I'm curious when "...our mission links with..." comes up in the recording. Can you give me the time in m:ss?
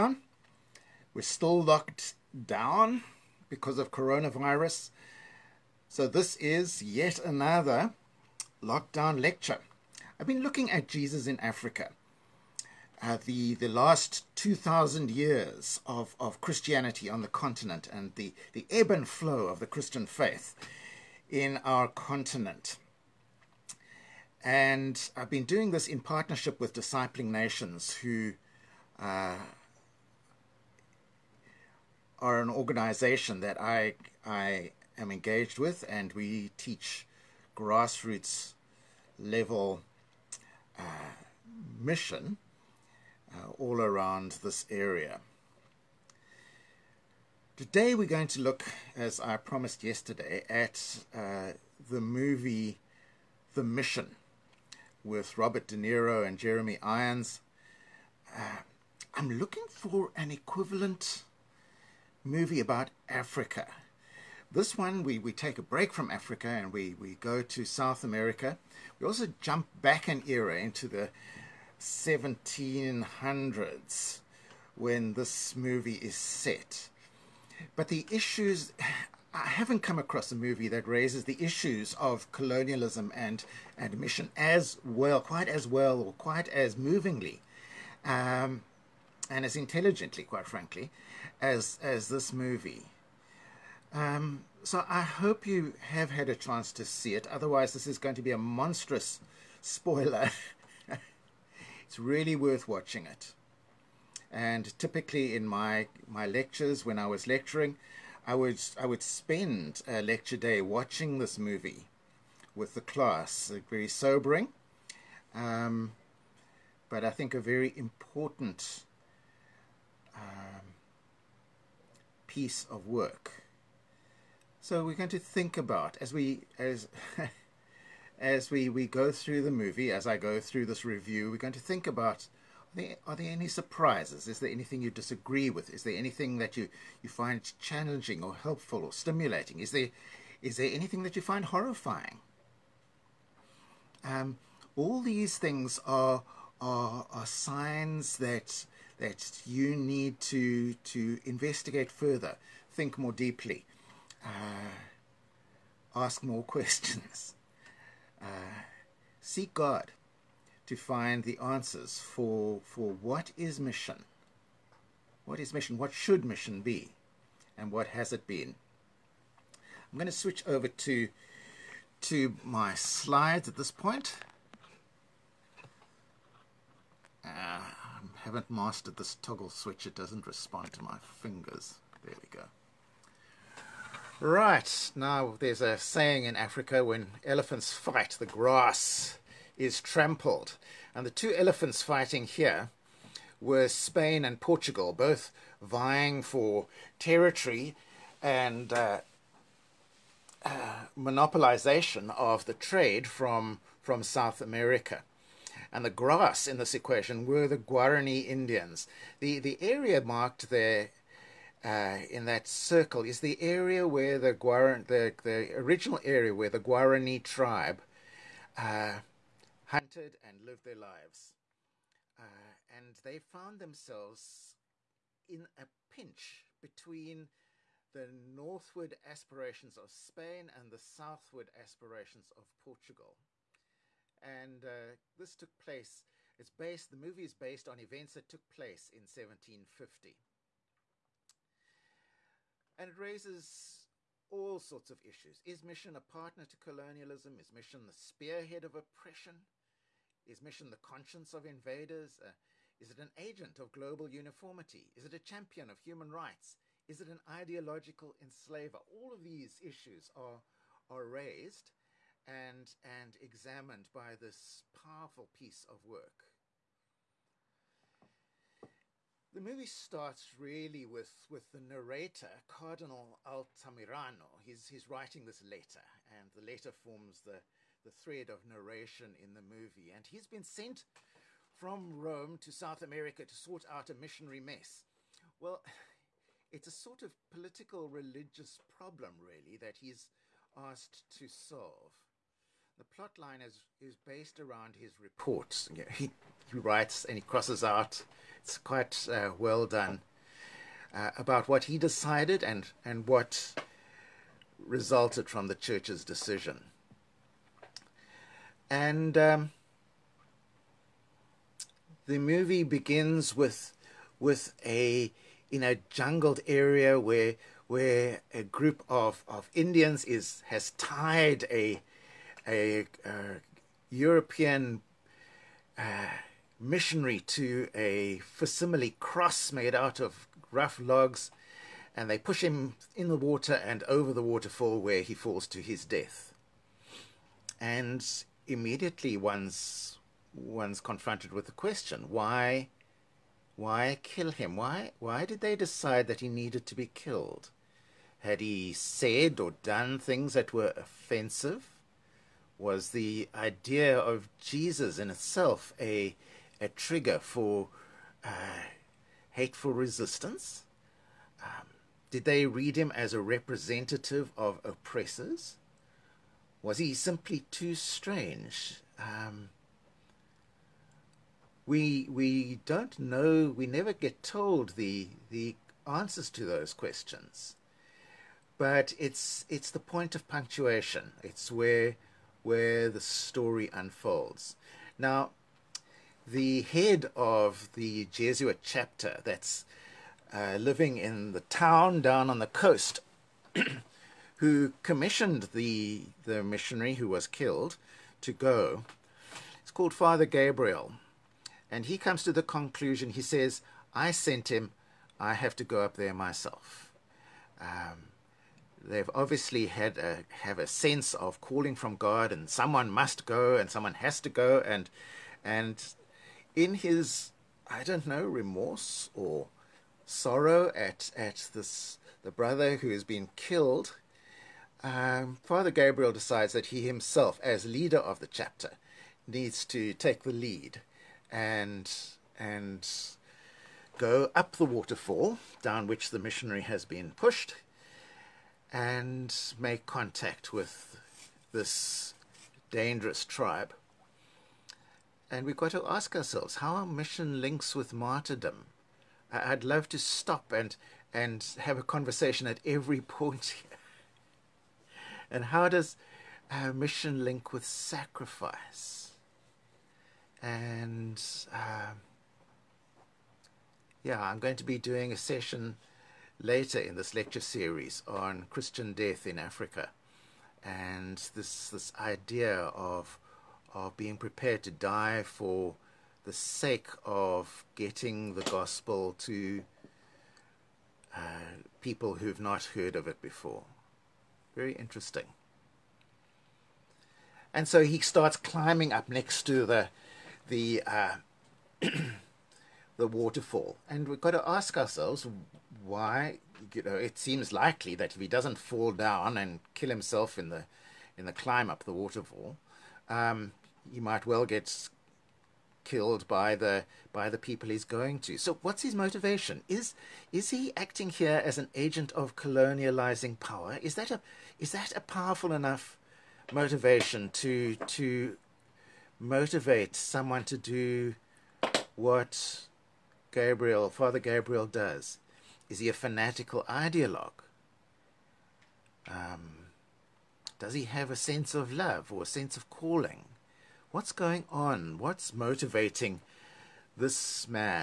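7:26.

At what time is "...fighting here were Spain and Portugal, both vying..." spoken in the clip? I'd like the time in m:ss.
3:11.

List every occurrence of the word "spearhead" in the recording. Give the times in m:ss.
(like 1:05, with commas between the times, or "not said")
4:07.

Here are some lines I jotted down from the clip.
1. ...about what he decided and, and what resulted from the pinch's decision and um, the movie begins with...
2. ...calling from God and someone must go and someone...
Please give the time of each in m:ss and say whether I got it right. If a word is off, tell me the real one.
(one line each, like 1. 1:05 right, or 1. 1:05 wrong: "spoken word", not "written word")
1. 5:01 wrong: "church", not "pinch"
2. 6:51 right.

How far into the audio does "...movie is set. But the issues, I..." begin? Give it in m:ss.
1:15.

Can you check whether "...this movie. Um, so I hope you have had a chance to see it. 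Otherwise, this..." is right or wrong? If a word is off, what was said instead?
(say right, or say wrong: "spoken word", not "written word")
right.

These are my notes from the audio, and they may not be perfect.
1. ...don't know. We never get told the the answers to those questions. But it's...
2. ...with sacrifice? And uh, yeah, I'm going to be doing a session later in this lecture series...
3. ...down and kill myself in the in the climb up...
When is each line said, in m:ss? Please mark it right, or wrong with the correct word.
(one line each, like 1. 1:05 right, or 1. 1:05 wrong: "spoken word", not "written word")
1. 6:12 right
2. 7:37 right
3. 8:18 wrong: "himself", not "myself".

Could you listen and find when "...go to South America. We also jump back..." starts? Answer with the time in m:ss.
1:07.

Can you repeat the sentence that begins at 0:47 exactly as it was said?
Today we're going to look, as I promised yesterday, at uh, the movie The Mission with Robert De Niro and Jeremy Irons.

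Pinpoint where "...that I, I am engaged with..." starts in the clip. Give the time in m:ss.
0:33.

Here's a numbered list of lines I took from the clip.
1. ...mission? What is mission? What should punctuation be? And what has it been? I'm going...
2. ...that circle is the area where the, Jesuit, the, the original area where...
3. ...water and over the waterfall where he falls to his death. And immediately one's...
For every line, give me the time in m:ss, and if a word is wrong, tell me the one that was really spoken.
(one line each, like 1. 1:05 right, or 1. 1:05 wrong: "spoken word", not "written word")
1. 2:43 wrong: "mission", not "punctuation"
2. 3:32 wrong: "Guaran", not "Jesuit"
3. 5:33 right.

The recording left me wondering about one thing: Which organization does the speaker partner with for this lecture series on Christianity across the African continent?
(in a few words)
Discipling Nations.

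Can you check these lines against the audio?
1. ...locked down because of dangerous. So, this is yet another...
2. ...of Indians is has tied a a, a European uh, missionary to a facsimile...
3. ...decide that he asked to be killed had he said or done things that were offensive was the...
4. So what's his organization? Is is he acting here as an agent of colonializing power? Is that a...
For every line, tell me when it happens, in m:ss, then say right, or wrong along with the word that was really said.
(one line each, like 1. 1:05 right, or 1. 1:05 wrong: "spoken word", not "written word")
1. 0:01 wrong: "coronavirus", not "dangerous"
2. 5:19 right
3. 5:45 wrong: "needed", not "asked"
4. 8:28 wrong: "motivation", not "organization".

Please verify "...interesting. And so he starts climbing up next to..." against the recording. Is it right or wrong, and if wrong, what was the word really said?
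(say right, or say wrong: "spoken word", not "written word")
right.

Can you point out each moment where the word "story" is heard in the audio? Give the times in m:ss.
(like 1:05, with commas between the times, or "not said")
6:22.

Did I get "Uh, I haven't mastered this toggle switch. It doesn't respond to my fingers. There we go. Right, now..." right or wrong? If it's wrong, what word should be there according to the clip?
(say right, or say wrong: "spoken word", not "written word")
right.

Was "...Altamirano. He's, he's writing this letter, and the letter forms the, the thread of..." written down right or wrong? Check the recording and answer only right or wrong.
right.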